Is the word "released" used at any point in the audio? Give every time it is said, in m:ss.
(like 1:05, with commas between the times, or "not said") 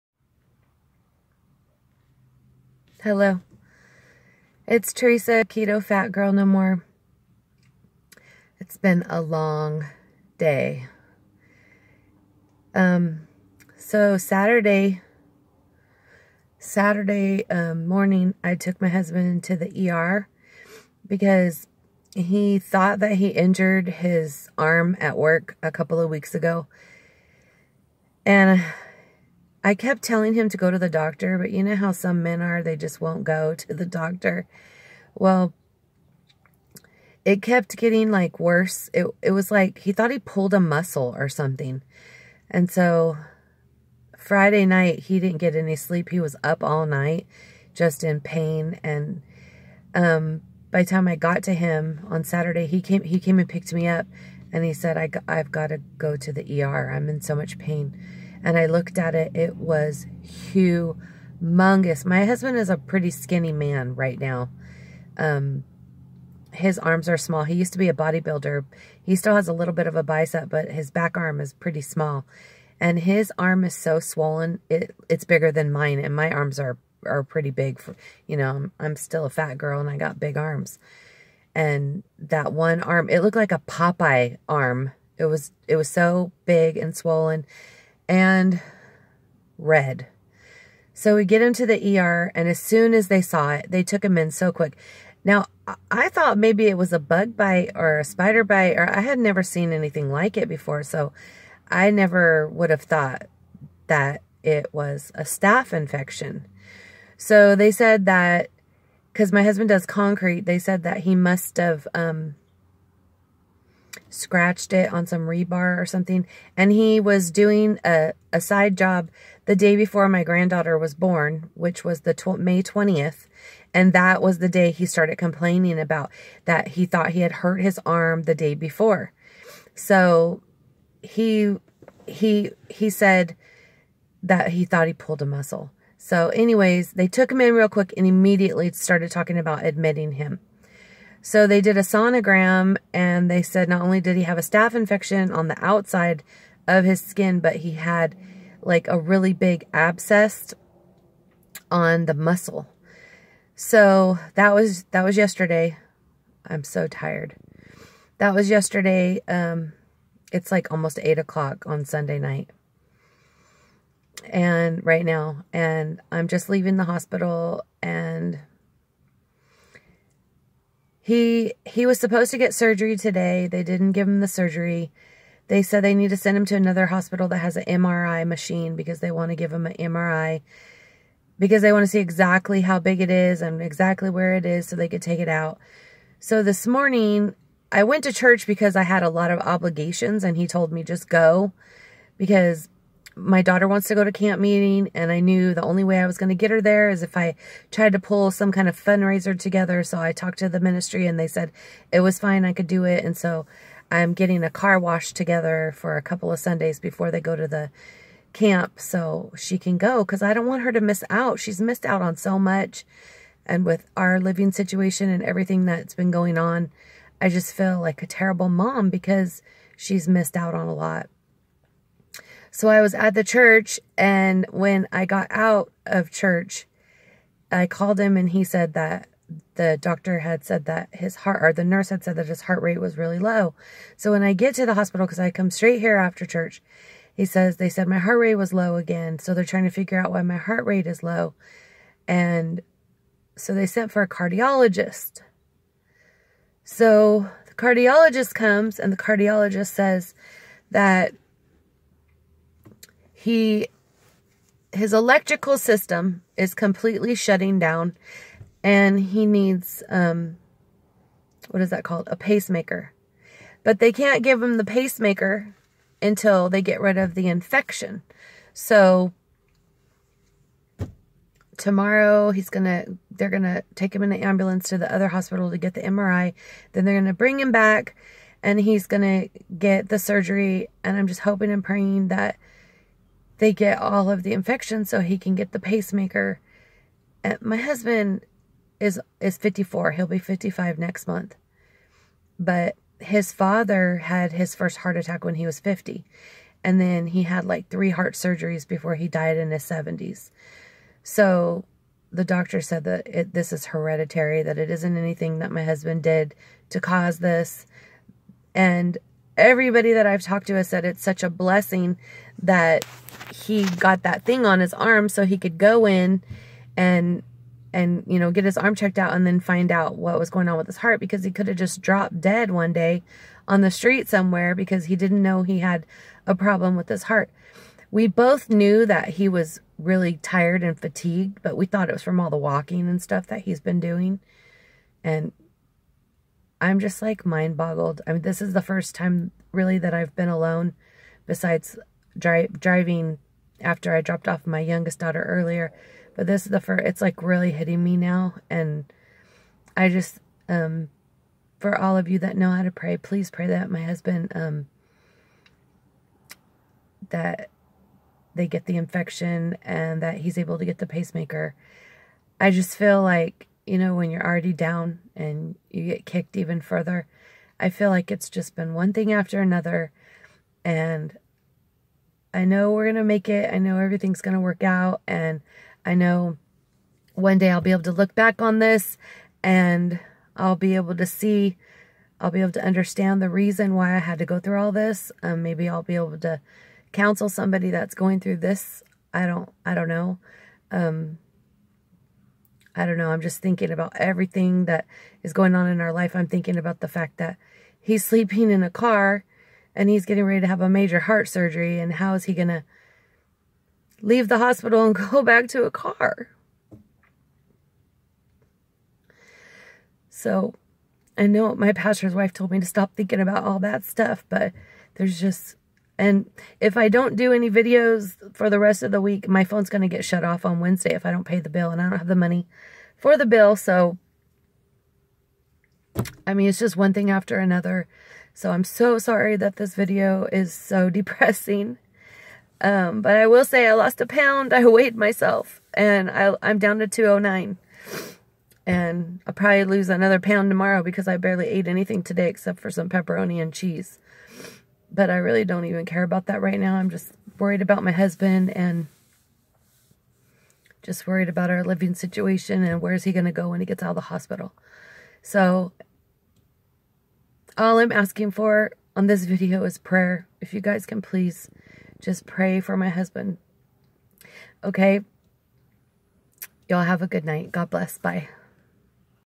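not said.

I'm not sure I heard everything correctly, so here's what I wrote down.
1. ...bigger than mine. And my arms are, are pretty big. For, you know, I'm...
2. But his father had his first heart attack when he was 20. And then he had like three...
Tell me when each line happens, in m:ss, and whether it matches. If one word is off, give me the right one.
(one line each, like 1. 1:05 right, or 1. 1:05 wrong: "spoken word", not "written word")
1. 1:15 right
2. 4:52 wrong: "50", not "20".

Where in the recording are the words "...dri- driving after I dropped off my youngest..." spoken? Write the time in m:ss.
5:42.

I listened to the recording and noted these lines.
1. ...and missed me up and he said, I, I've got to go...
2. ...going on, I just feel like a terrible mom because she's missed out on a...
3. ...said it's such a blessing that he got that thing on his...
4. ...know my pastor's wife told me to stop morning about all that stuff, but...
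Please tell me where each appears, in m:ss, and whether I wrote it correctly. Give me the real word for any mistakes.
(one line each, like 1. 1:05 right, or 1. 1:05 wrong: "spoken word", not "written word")
1. 0:53 wrong: "picked", not "missed"
2. 3:36 right
3. 5:10 right
4. 6:51 wrong: "thinking", not "morning".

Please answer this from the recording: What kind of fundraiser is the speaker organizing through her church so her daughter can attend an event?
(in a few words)
Car wash.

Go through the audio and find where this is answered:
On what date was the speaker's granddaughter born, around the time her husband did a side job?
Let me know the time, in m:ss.
2:02.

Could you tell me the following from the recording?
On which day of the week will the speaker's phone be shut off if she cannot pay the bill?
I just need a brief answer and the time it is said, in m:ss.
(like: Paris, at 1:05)
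Wednesday, at 7:00.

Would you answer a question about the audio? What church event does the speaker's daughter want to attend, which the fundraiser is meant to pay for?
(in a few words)
Camp meeting.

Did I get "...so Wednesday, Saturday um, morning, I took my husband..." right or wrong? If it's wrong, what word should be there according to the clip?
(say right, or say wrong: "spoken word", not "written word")
wrong: "Saturday", not "Wednesday".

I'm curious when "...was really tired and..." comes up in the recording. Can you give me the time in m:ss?
5:29.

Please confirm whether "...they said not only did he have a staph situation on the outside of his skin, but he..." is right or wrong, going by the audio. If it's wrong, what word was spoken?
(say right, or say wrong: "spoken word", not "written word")
wrong: "infection", not "situation".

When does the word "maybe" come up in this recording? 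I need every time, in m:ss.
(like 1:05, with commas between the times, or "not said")
1:36, 6:25.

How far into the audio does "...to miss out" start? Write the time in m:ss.
3:30.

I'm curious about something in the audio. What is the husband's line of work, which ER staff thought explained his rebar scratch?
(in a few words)
Concrete.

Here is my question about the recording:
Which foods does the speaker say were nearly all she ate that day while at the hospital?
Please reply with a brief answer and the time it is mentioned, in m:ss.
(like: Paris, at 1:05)
Pepperoni and cheese, at 7:22.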